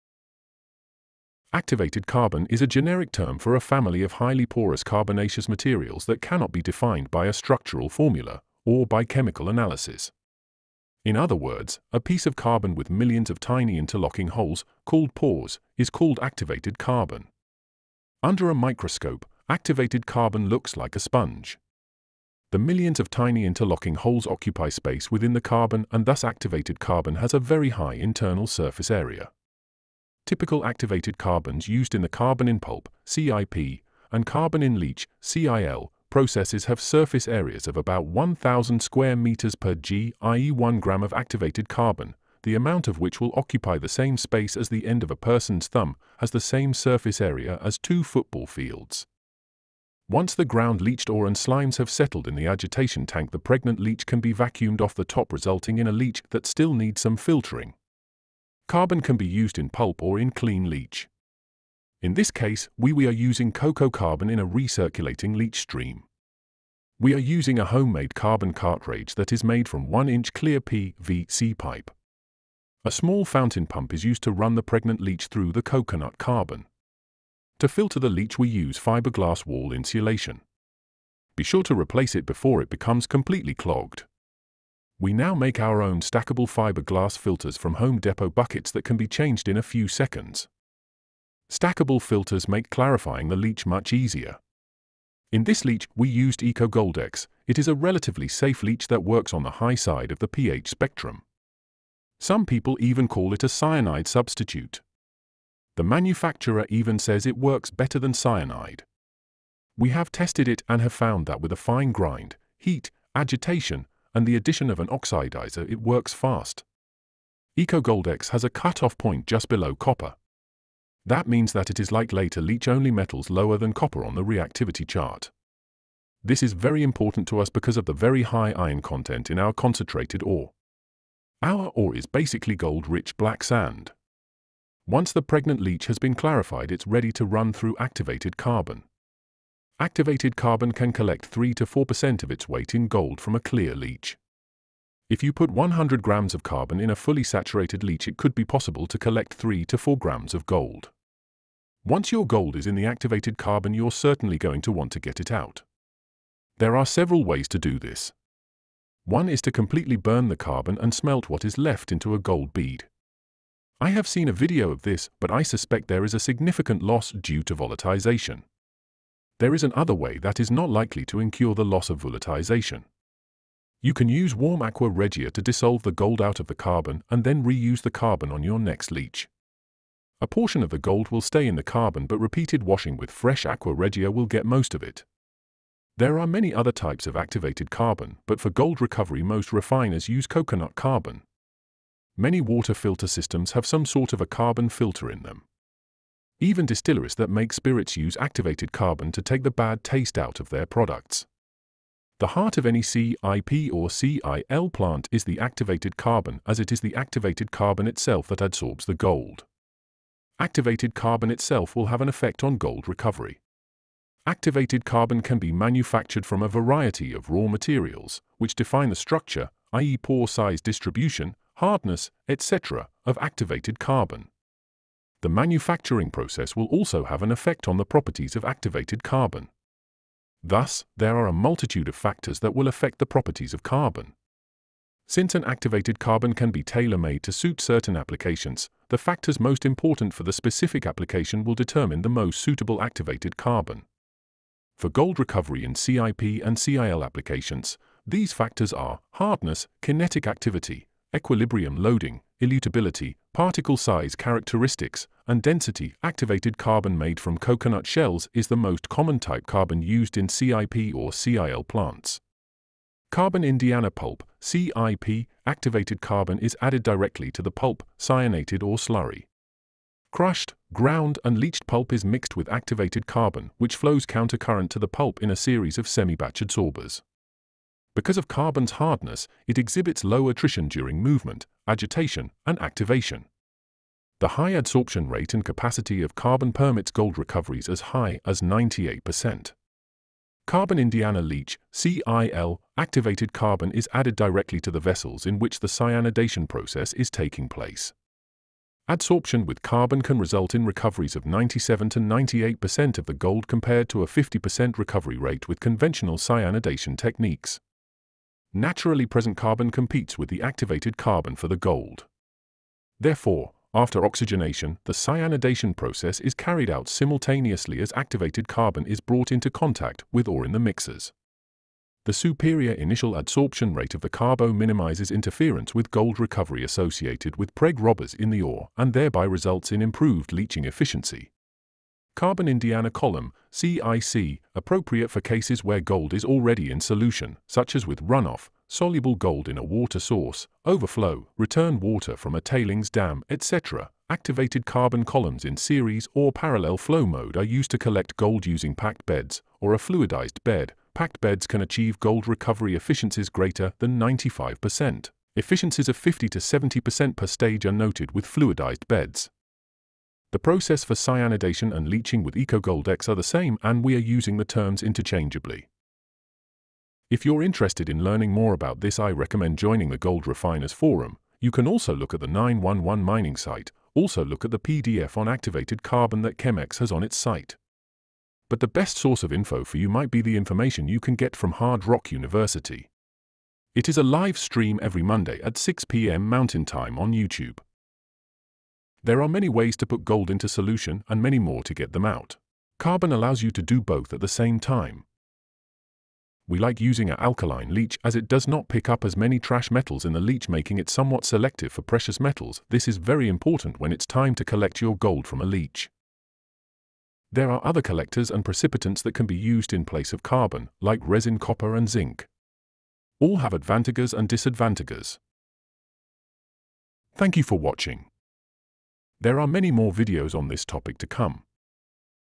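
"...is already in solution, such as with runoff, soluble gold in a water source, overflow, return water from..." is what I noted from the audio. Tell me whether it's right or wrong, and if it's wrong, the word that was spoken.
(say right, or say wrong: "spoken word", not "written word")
right.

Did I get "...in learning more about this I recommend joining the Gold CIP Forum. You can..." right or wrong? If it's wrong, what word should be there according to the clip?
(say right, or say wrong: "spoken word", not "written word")
wrong: "Refiners", not "CIP".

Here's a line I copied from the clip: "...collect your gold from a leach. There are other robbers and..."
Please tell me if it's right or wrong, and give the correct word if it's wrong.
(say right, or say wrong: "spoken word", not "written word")
wrong: "collectors", not "robbers".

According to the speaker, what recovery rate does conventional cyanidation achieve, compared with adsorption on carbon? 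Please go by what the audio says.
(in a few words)
50%.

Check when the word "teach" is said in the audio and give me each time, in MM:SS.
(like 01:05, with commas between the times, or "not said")
not said.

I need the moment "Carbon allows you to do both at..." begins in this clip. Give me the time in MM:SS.
06:32.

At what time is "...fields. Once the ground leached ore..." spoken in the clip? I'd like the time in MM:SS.
00:48.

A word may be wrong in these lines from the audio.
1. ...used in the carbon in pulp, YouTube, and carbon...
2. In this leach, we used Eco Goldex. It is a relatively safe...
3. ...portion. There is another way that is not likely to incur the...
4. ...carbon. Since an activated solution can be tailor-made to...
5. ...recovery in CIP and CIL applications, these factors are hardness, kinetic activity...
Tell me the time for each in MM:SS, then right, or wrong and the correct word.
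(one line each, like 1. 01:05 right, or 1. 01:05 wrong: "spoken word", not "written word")
1. 00:31 wrong: "CIP", not "YouTube"
2. 01:35 right
3. 02:47 wrong: "volatilization", not "portion"
4. 03:53 wrong: "carbon", not "solution"
5. 04:05 right.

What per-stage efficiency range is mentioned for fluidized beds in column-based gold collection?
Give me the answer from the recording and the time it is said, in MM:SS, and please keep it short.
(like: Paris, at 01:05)
50 to 70%, at 05:55.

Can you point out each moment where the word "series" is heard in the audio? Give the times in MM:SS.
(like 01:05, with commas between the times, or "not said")
04:35, 05:45.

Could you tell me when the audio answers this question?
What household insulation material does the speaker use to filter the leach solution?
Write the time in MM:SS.
01:18.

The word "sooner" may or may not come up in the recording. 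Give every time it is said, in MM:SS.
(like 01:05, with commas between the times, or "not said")
not said.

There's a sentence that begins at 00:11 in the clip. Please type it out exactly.
In other words, a piece of carbon with millions of tiny interlocking holes, called pores, is called activated carbon.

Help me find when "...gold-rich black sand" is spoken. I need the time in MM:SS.
02:12.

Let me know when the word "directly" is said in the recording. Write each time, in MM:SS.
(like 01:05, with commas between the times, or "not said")
04:26, 04:54.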